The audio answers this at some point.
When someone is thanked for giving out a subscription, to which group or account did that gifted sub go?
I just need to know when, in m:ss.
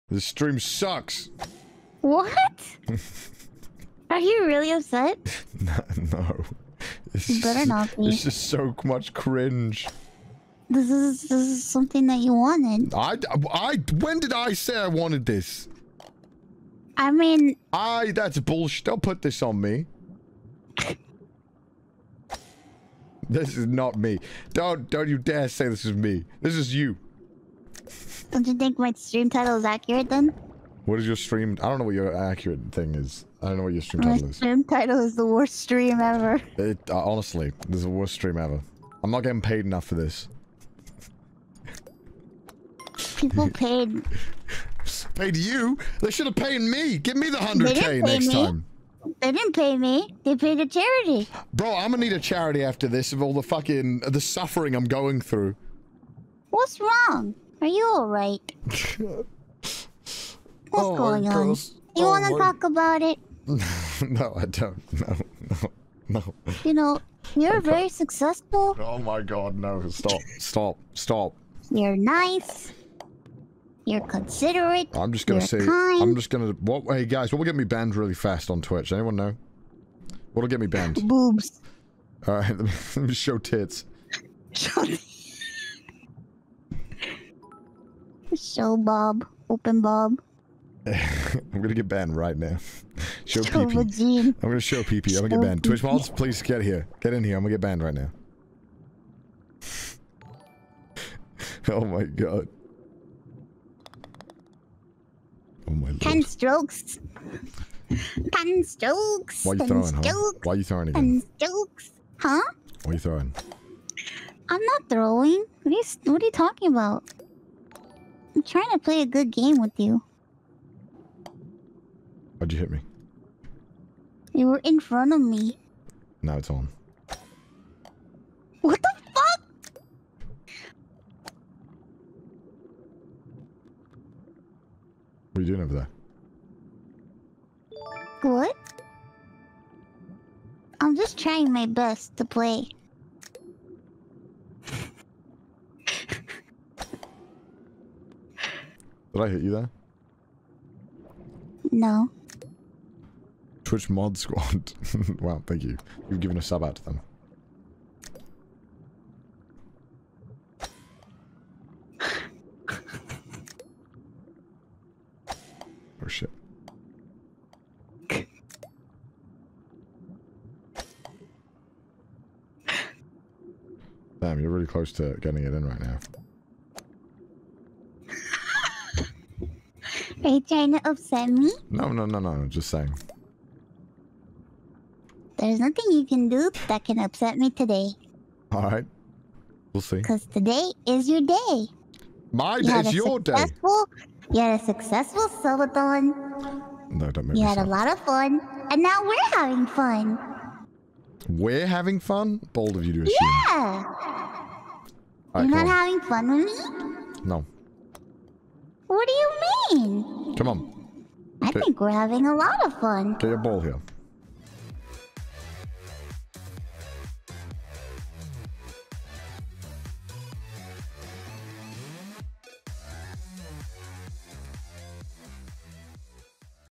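2:33.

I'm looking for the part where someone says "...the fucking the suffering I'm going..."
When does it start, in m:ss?
0:53.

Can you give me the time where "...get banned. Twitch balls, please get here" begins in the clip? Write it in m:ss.
1:35.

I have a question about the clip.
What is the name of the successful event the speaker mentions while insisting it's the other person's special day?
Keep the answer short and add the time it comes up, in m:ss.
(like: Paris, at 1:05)
Silvathon, at 3:15.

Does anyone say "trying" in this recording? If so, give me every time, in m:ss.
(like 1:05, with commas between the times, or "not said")
1:58, 2:21, 3:00.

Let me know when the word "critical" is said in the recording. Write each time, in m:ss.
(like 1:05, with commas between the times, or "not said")
not said.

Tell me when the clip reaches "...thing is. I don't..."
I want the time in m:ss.
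0:32.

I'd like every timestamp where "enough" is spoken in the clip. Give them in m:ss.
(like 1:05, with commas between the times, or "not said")
0:39.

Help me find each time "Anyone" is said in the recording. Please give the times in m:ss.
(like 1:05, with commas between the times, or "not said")
1:18.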